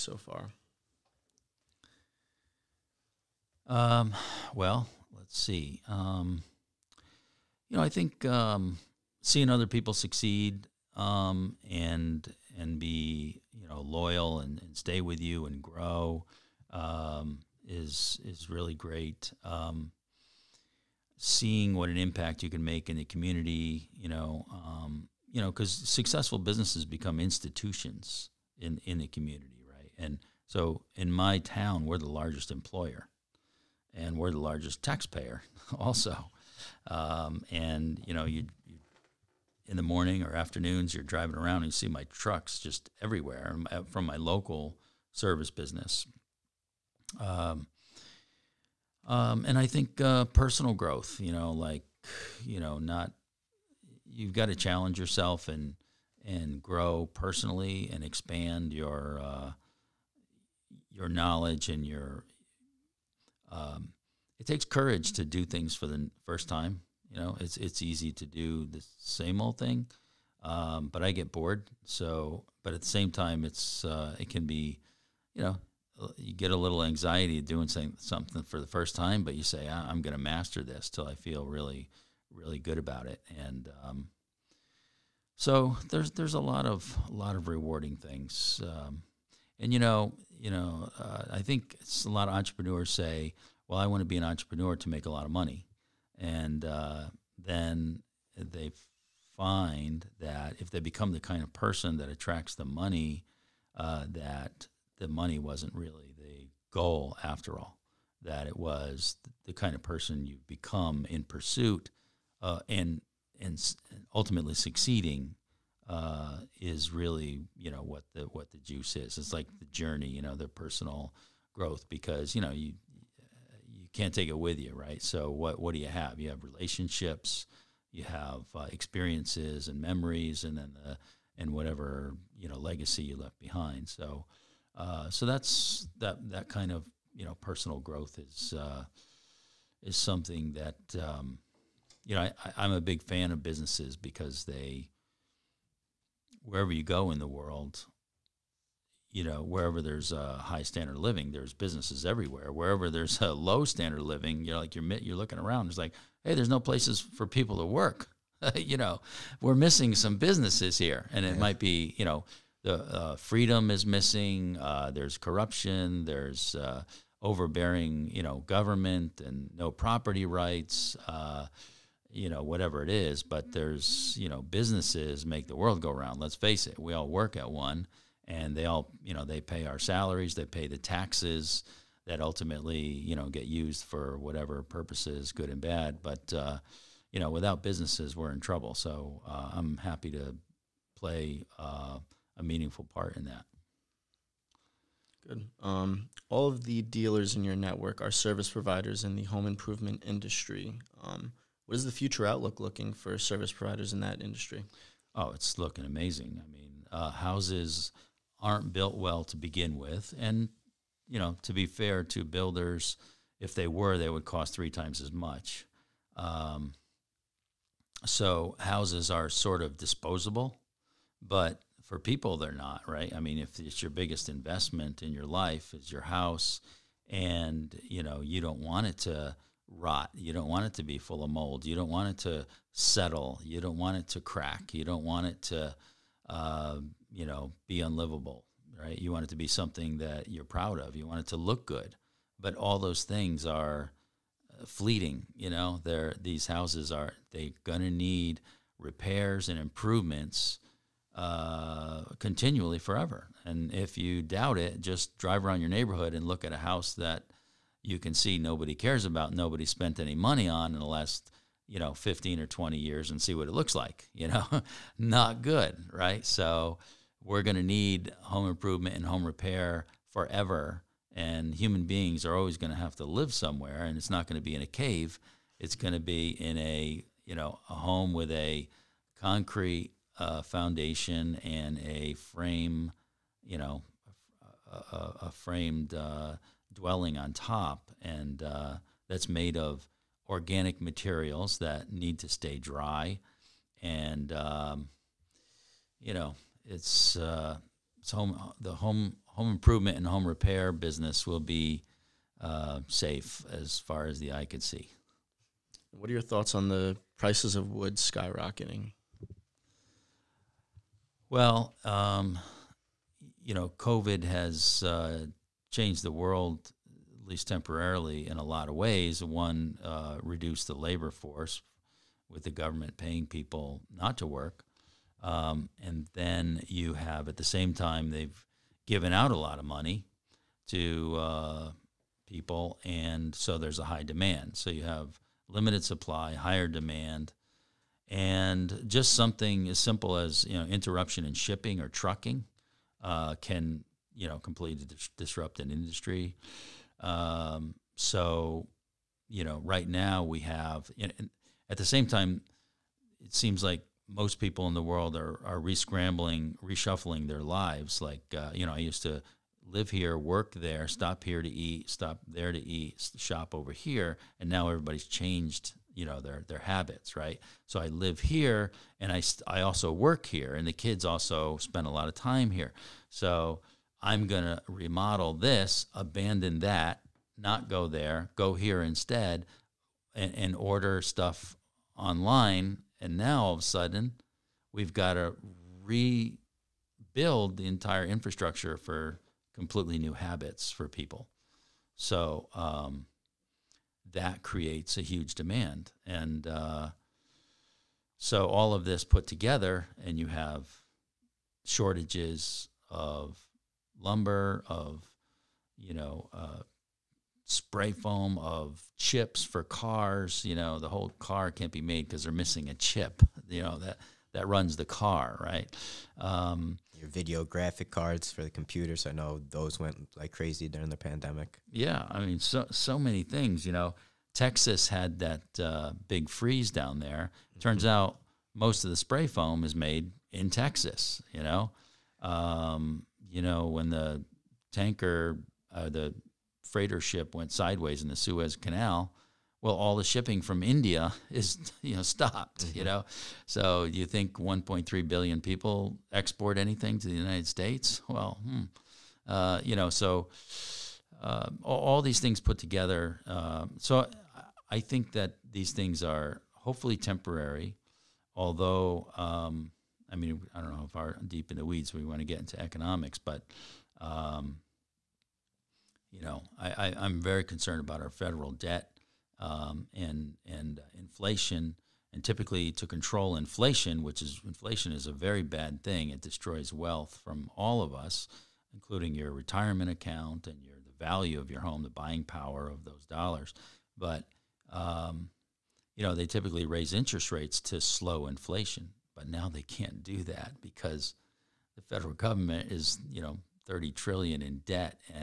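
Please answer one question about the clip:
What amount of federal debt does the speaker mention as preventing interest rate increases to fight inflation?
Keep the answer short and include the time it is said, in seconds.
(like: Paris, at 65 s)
30 trillion, at 493 s.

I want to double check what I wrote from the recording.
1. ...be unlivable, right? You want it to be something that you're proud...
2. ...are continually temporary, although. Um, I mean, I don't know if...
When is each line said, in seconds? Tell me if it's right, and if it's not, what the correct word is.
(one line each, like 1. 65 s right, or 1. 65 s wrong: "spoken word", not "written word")
1. 237 s right
2. 456 s wrong: "hopefully", not "continually".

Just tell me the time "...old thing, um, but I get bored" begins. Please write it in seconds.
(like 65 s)
69 s.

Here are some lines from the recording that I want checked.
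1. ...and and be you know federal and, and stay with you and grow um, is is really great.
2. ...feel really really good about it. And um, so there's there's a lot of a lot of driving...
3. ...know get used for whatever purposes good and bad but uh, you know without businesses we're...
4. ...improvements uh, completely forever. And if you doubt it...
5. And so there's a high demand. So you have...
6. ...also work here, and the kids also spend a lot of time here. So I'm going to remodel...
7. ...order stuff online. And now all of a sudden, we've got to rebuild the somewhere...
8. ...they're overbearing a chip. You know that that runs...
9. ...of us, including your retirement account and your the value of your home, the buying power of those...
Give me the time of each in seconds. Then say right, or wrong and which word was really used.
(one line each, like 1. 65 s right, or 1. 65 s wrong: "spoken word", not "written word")
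1. 11 s wrong: "loyal", not "federal"
2. 81 s wrong: "rewarding", not "driving"
3. 183 s right
4. 249 s wrong: "continually", not "completely"
5. 332 s right
6. 369 s right
7. 380 s wrong: "entire", not "somewhere"
8. 412 s wrong: "missing", not "overbearing"
9. 477 s right.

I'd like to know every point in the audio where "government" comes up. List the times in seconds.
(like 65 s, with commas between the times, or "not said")
168 s, 322 s, 492 s.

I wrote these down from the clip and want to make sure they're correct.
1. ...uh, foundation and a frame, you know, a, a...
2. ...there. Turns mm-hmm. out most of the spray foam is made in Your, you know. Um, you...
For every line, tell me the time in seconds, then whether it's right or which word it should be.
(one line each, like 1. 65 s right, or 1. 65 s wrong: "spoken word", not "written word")
1. 280 s right
2. 426 s wrong: "Texas", not "Your".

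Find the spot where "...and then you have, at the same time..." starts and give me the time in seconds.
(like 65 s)
325 s.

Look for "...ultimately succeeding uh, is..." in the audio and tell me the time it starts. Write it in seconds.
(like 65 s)
114 s.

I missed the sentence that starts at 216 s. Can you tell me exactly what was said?
Um, so houses are sort of disposable, but for people they're not right.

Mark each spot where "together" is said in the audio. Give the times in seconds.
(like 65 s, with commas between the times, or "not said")
399 s, 452 s.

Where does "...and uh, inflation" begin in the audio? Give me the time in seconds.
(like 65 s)
470 s.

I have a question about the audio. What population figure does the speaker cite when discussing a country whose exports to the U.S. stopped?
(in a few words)
1.3 billion.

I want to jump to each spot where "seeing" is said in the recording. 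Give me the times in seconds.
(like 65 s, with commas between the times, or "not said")
9 s, 21 s.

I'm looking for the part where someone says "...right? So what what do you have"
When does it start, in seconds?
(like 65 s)
124 s.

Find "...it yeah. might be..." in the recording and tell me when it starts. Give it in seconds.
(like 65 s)
161 s.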